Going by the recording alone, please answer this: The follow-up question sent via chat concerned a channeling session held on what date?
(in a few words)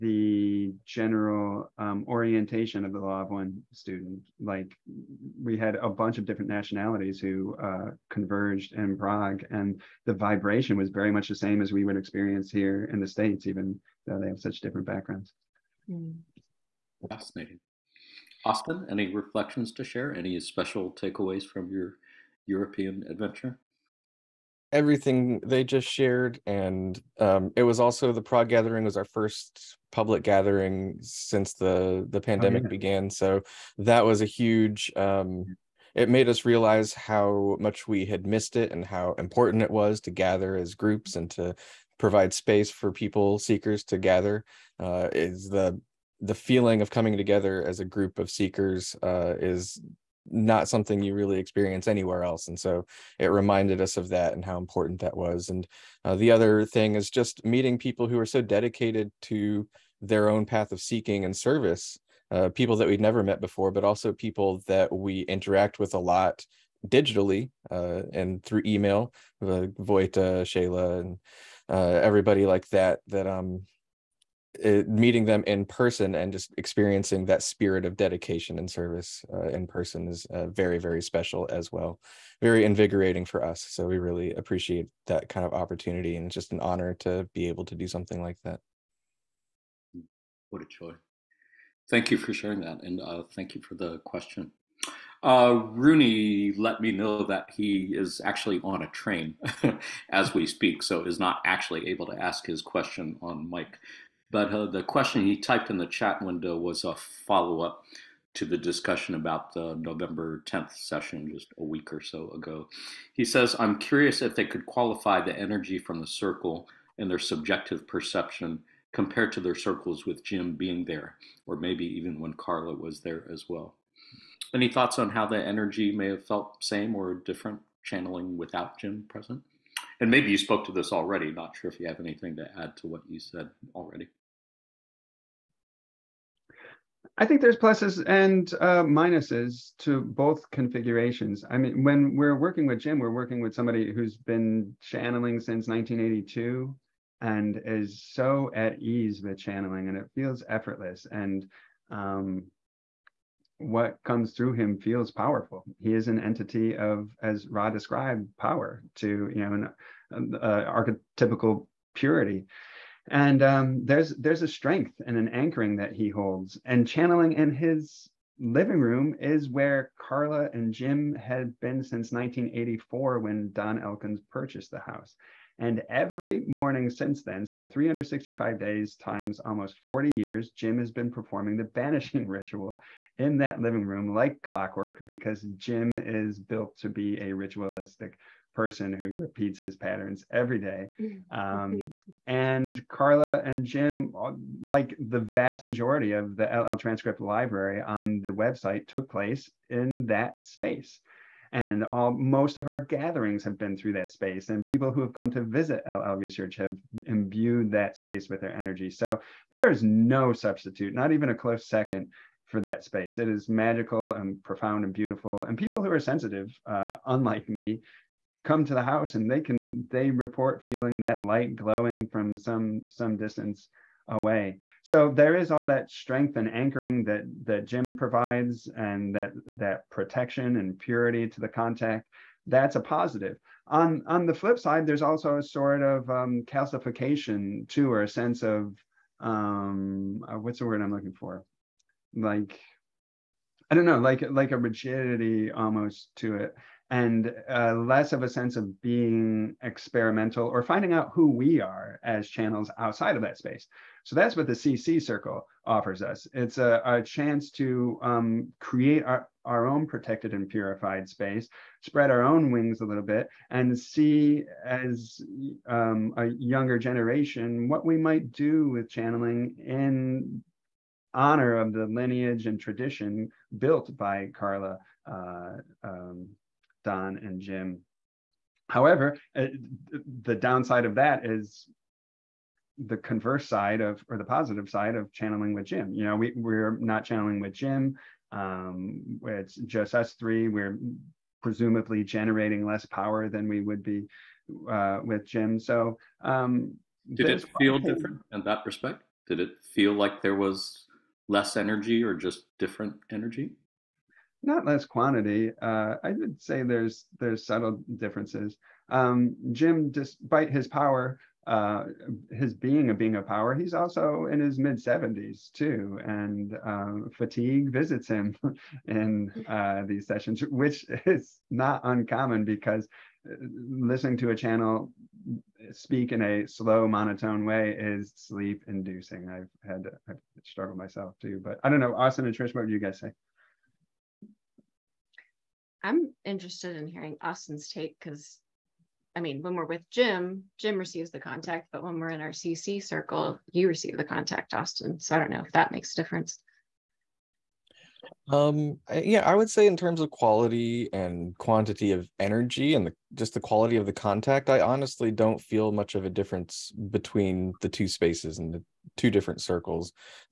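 November 10th.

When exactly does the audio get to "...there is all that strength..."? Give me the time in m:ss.
3:45.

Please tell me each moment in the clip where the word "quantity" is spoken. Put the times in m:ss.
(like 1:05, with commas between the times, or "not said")
5:04, 5:51.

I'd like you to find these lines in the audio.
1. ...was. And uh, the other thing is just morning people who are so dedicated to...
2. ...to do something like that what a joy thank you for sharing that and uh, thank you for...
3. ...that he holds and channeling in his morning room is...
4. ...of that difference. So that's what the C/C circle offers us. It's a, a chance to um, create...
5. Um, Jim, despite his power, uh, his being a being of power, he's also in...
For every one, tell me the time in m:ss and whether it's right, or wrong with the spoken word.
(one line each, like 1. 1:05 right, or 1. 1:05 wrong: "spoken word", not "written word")
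1. 0:55 wrong: "meeting", not "morning"
2. 1:27 right
3. 2:45 wrong: "living", not "morning"
4. 4:13 wrong: "space", not "difference"
5. 5:08 right.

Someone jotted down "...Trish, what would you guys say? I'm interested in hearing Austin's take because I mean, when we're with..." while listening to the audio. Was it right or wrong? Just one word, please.
right.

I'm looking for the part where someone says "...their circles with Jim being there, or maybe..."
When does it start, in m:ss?
1:59.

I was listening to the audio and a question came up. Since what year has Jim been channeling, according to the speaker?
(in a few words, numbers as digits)
1982.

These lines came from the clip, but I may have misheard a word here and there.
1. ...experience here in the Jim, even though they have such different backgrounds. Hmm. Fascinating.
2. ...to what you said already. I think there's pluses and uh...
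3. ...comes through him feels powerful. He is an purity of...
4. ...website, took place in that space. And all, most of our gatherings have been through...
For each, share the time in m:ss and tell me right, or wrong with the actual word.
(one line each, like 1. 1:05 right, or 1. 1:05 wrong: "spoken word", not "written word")
1. 0:11 wrong: "States", not "Jim"
2. 2:12 right
3. 2:34 wrong: "entity", not "purity"
4. 3:18 right.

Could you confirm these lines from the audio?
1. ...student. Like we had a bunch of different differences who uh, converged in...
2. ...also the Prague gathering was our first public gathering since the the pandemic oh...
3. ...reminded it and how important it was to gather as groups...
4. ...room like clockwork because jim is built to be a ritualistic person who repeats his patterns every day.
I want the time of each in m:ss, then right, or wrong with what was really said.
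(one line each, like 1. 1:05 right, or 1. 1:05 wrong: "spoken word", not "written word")
1. 0:03 wrong: "nationalities", not "differences"
2. 0:27 right
3. 0:38 wrong: "missed", not "reminded"
4. 3:03 right.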